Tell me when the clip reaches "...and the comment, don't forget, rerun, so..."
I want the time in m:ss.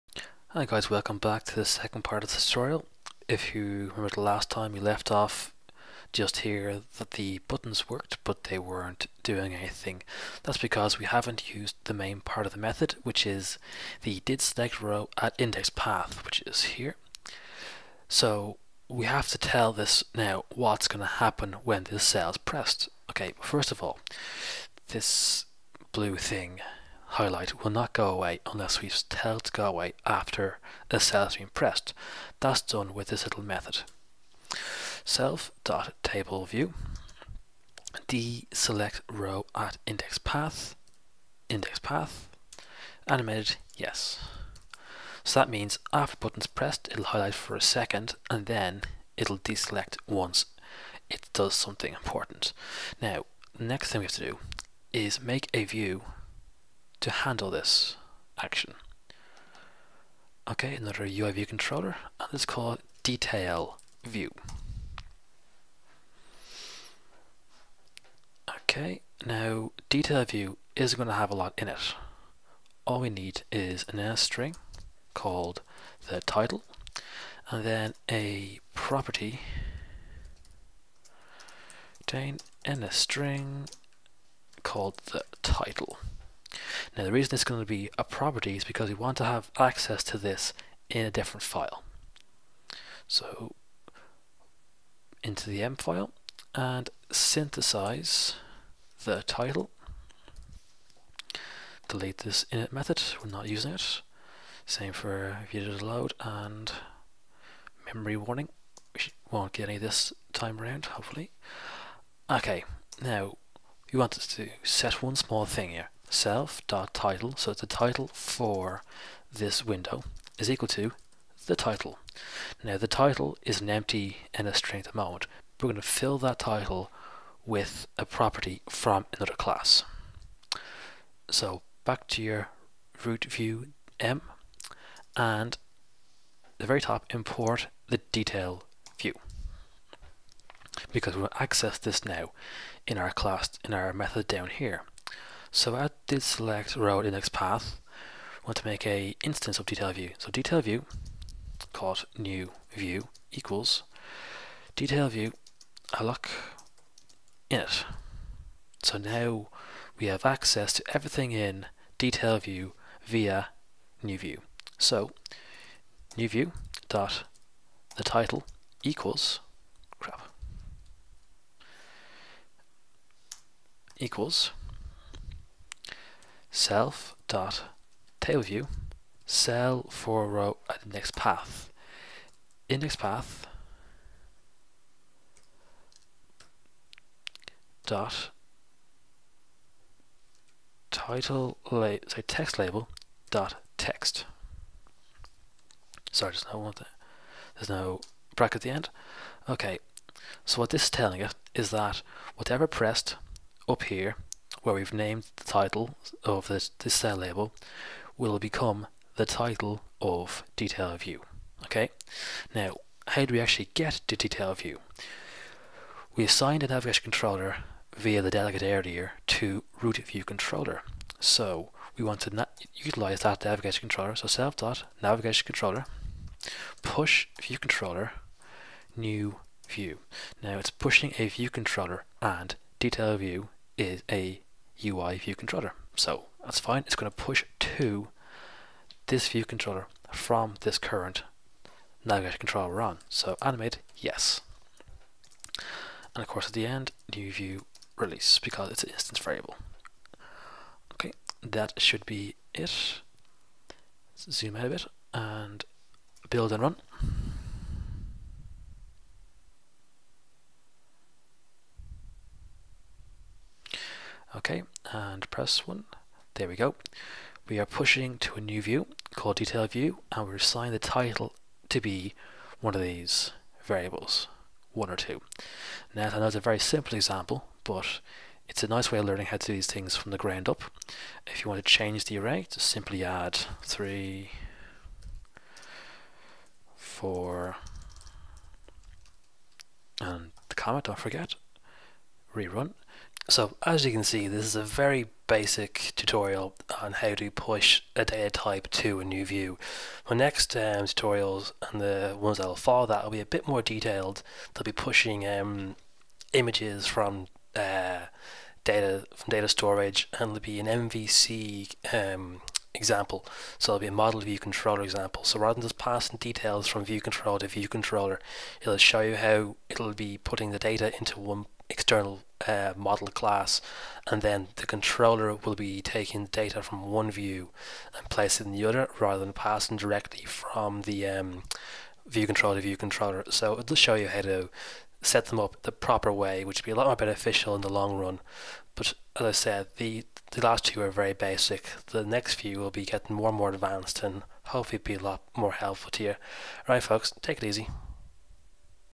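4:49.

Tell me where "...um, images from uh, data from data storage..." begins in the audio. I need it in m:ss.
5:05.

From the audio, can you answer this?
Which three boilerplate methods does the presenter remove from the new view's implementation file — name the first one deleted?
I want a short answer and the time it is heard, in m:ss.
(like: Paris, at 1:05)
init method, at 1:42.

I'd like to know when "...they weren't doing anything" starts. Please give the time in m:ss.
0:08.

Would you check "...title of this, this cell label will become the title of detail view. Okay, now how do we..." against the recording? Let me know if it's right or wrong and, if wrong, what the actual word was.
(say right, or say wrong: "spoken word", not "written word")
right.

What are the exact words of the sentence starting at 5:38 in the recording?
But as I said, the, the last two are very basic.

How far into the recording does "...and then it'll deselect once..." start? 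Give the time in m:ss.
0:48.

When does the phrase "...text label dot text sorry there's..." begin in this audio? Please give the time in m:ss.
3:12.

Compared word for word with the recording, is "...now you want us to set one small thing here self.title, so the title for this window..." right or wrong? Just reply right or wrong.
right.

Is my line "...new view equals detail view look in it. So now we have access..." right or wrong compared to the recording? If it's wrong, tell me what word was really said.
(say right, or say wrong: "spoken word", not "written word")
right.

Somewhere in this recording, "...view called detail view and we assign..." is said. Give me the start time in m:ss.
4:28.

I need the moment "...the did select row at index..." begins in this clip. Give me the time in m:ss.
0:14.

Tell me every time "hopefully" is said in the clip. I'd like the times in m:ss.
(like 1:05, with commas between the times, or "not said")
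1:50, 5:44.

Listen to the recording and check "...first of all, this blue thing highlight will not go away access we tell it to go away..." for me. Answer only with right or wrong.
wrong.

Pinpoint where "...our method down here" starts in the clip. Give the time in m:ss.
2:23.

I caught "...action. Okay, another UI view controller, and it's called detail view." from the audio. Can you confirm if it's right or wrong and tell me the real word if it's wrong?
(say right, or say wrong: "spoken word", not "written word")
right.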